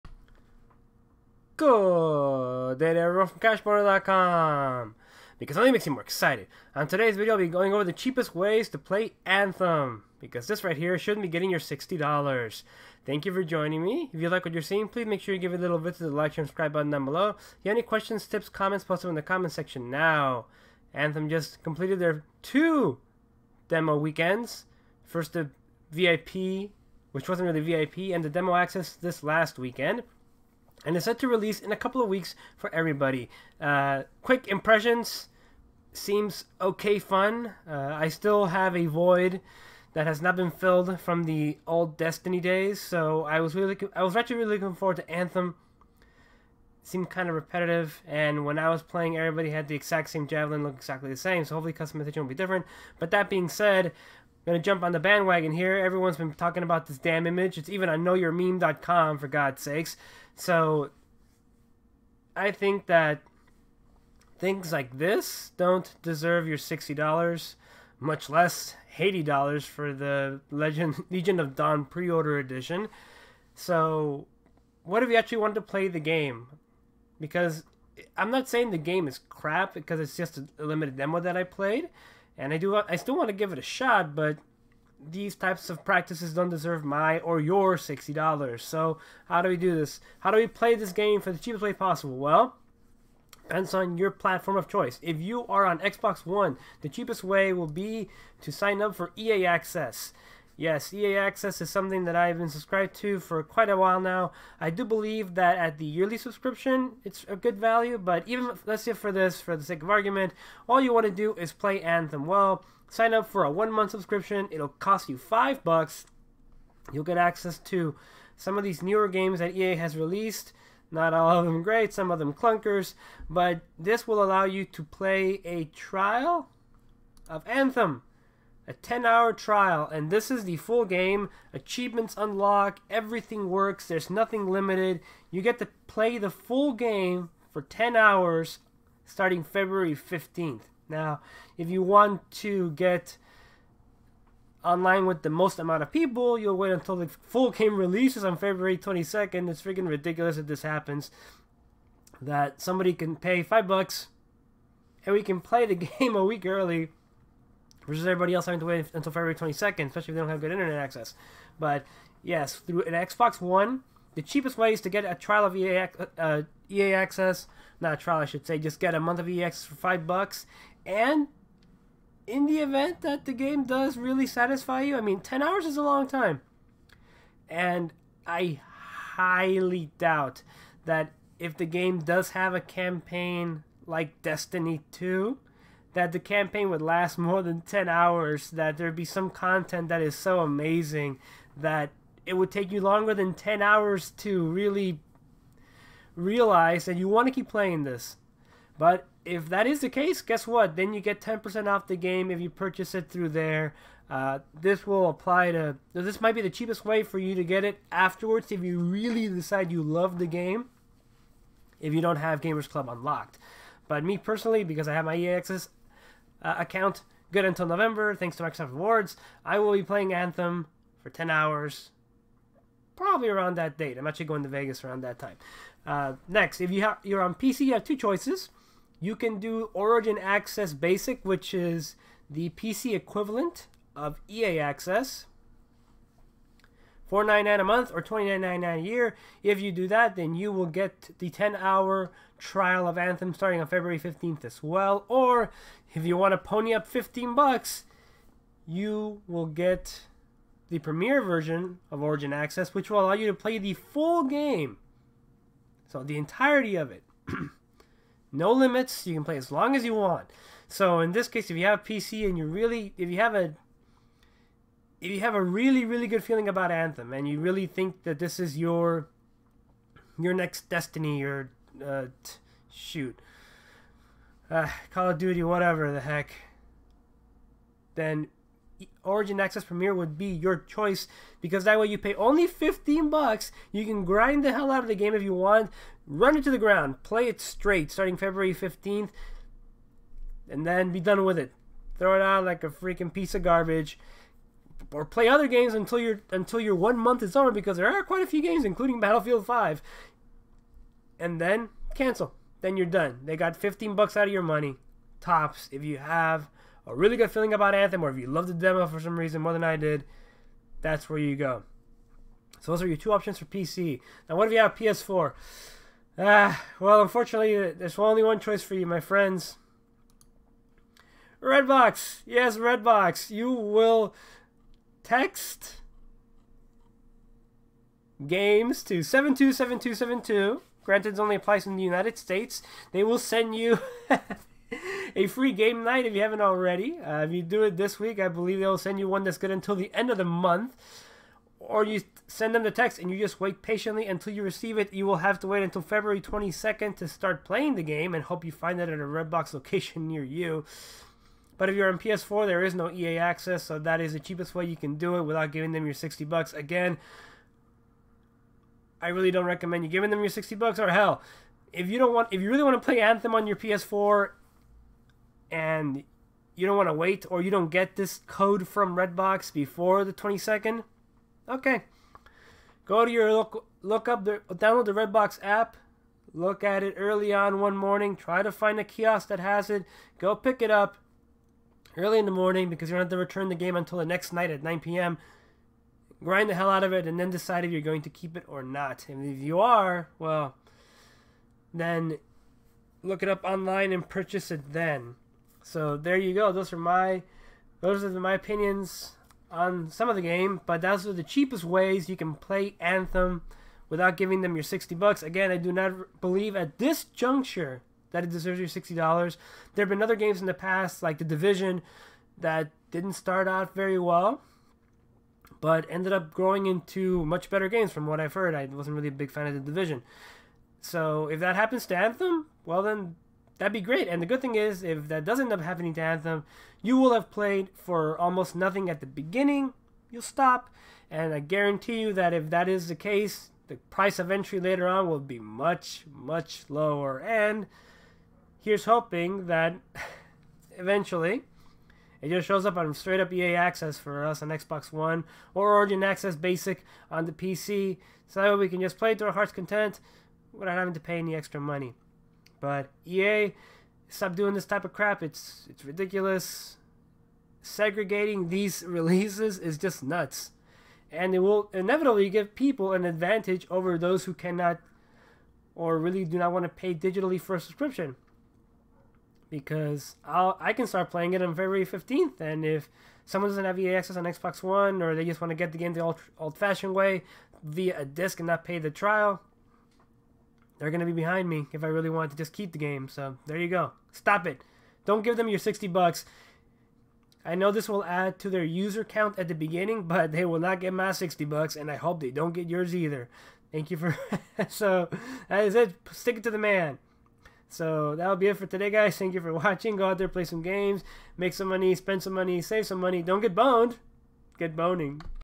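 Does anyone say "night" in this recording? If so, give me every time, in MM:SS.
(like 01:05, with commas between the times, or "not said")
05:35, 06:24.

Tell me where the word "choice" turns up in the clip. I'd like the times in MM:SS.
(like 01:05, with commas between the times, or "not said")
01:34, 03:47, 04:40, 05:18.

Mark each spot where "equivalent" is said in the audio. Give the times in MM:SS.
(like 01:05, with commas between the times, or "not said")
03:52.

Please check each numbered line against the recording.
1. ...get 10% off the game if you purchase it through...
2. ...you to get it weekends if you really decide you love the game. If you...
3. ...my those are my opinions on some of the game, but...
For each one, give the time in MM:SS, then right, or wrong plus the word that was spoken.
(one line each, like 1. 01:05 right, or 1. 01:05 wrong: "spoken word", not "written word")
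1. 03:21 right
2. 03:27 wrong: "afterwards", not "weekends"
3. 06:36 right.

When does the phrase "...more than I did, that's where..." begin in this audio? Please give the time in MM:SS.
05:09.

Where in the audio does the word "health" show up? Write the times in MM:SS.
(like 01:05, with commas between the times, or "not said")
not said.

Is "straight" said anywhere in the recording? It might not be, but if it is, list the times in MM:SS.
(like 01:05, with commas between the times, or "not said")
04:47, 07:22.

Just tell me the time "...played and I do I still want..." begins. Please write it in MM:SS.
01:21.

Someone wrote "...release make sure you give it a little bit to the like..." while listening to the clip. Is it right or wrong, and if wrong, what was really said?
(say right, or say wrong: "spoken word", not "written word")
wrong: "please", not "release".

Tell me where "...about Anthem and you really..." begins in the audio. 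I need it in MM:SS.
04:26.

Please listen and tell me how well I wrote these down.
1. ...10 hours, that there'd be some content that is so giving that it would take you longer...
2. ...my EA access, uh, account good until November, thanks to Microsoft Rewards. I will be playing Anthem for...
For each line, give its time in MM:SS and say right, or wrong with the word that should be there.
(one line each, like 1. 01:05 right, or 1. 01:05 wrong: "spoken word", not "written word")
1. 03:07 wrong: "amazing", not "giving"
2. 03:35 right.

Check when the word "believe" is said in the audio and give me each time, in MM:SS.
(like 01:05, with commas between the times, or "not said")
01:44, 05:38, 06:46.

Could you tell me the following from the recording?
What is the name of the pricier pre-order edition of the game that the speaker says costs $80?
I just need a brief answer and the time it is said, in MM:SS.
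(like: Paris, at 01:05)
Legion of Dawn, at 01:11.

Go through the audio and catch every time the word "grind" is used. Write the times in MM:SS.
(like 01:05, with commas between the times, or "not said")
04:44, 06:26.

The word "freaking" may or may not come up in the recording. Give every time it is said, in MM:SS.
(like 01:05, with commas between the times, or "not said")
02:29, 04:52.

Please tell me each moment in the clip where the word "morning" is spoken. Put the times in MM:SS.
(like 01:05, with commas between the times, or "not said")
06:17, 06:22.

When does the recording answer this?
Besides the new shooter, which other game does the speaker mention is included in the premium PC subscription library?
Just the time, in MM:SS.
04:58.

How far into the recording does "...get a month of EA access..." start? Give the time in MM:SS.
02:48.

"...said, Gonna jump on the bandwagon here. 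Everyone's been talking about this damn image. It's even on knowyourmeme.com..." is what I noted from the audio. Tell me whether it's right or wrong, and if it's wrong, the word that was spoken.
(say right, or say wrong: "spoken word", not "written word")
right.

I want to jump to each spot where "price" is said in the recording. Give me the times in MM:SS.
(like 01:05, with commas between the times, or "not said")
07:13.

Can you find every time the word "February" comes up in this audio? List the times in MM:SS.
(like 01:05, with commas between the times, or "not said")
02:19, 02:28, 02:39, 04:03, 04:48, 05:45, 07:51.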